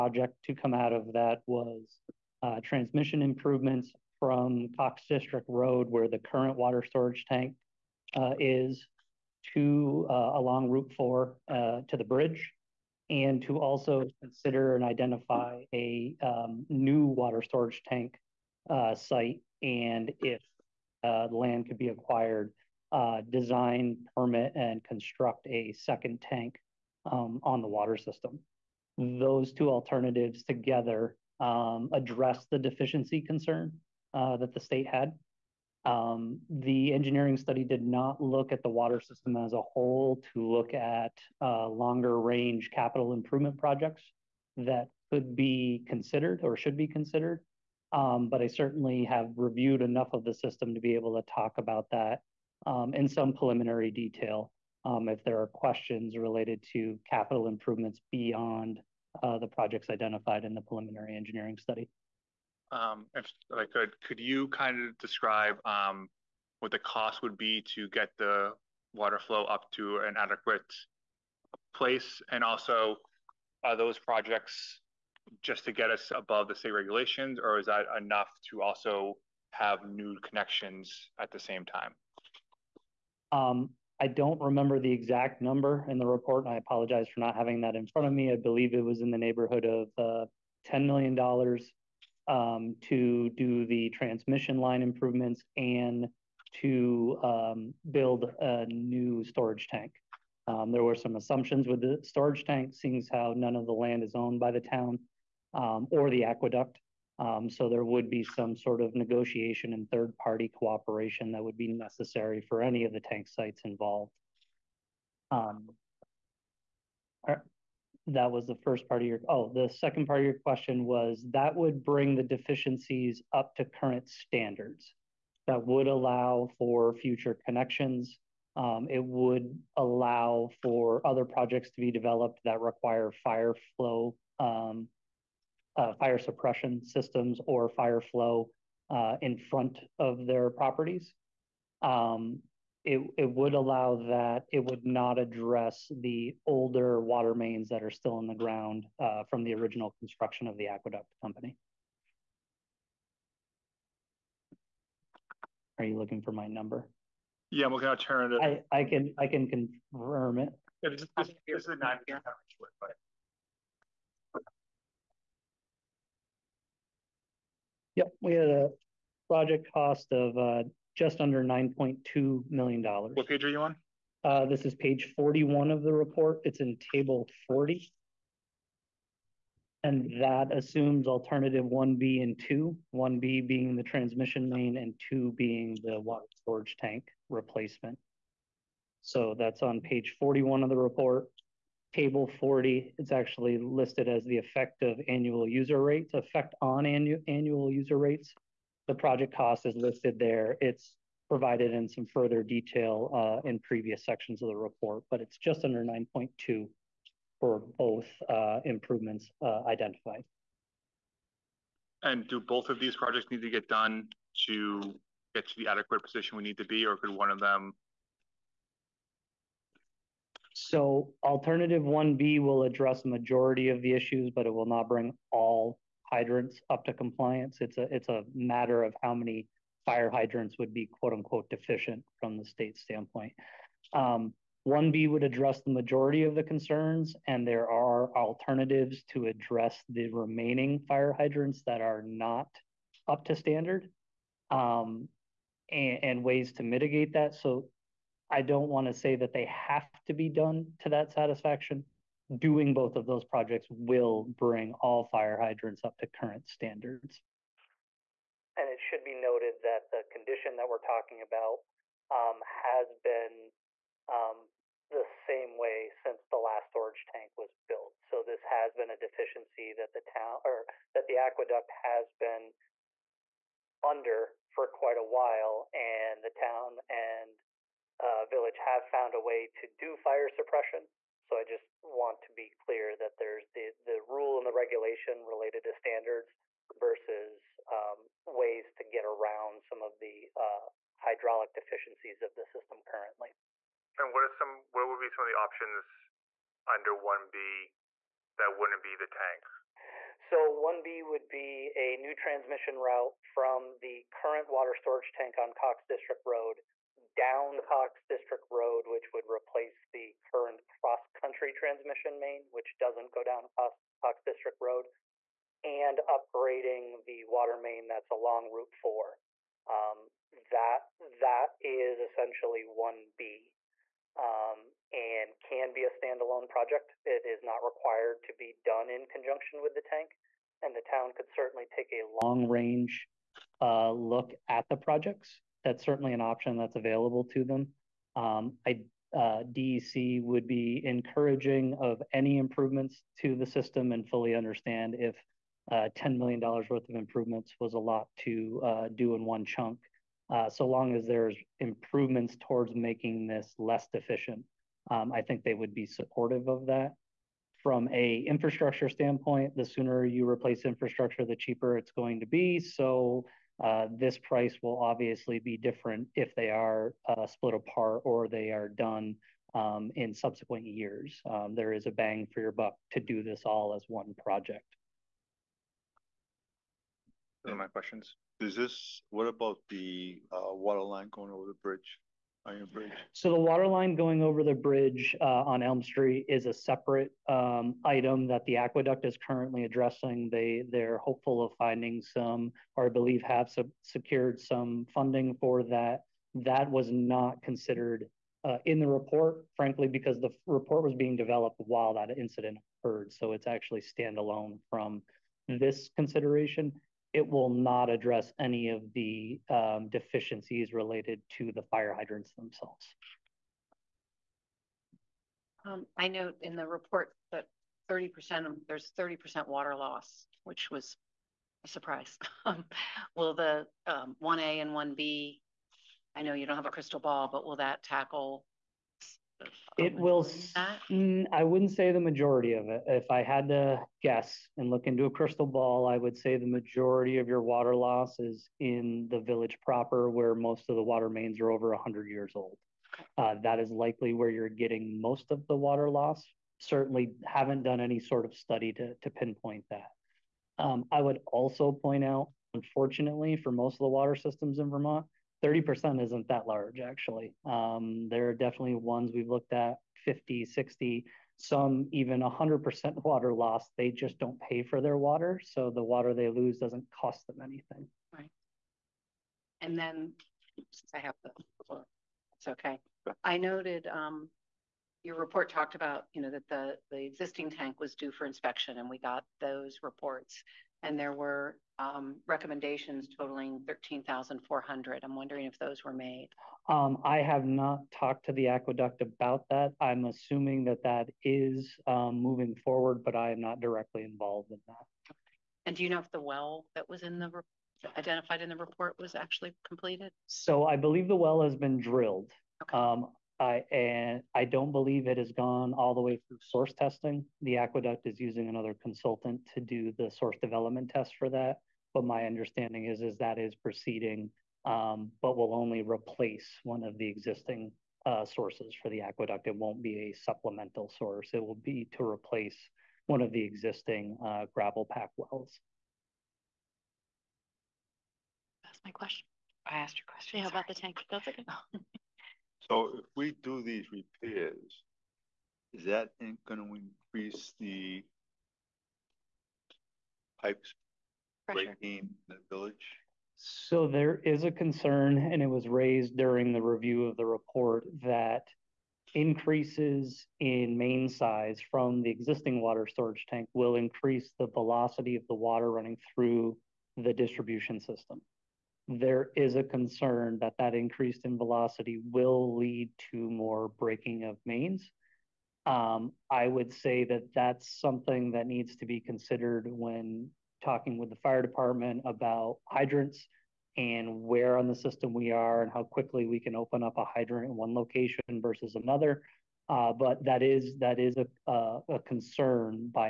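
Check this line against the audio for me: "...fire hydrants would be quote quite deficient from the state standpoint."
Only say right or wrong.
wrong.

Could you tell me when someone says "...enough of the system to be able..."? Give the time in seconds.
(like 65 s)
49 s.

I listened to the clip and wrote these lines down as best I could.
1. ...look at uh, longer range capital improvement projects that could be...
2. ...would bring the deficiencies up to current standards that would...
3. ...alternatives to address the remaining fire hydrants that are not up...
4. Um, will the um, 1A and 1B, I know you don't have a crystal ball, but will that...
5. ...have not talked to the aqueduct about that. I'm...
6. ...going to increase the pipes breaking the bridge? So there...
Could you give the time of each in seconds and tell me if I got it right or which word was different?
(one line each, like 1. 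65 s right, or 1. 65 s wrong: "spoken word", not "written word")
1. 40 s right
2. 121 s right
3. 238 s right
4. 422 s right
5. 487 s right
6. 536 s wrong: "village", not "bridge".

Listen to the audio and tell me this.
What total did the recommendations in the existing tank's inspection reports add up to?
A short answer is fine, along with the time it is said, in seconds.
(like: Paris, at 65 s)
13,400, at 483 s.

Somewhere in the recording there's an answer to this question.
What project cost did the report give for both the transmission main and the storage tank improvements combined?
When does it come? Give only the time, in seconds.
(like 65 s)
170 s.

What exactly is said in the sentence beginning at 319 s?
Um, that that is essentially 1B um, and can be a standalone project.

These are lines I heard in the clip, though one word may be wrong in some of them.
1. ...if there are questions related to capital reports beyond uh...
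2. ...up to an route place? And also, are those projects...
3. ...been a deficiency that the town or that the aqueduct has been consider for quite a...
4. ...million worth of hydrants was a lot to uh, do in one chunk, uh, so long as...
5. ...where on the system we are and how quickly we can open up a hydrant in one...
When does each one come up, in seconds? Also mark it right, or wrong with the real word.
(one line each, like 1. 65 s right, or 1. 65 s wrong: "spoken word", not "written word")
1. 55 s wrong: "improvements", not "reports"
2. 69 s wrong: "adequate", not "route"
3. 268 s wrong: "under", not "consider"
4. 346 s wrong: "improvements", not "hydrants"
5. 574 s right.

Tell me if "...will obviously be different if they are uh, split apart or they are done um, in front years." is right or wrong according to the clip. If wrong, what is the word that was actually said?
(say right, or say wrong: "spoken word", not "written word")
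wrong: "subsequent", not "front".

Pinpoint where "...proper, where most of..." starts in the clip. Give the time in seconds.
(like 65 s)
439 s.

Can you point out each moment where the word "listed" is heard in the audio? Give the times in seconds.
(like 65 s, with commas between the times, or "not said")
193 s, 199 s.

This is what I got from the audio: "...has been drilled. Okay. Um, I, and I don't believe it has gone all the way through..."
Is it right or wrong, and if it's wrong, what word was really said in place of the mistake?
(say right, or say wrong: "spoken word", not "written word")
right.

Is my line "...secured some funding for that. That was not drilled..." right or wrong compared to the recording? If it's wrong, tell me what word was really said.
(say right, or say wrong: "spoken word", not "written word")
wrong: "considered", not "drilled".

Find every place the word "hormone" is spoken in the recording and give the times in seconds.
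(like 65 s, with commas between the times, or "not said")
not said.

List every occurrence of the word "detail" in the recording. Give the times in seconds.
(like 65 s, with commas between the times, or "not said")
53 s, 202 s.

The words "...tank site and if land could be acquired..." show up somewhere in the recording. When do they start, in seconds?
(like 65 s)
17 s.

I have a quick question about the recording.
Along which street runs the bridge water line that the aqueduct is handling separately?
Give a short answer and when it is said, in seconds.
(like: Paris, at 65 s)
Elm Street, at 385 s.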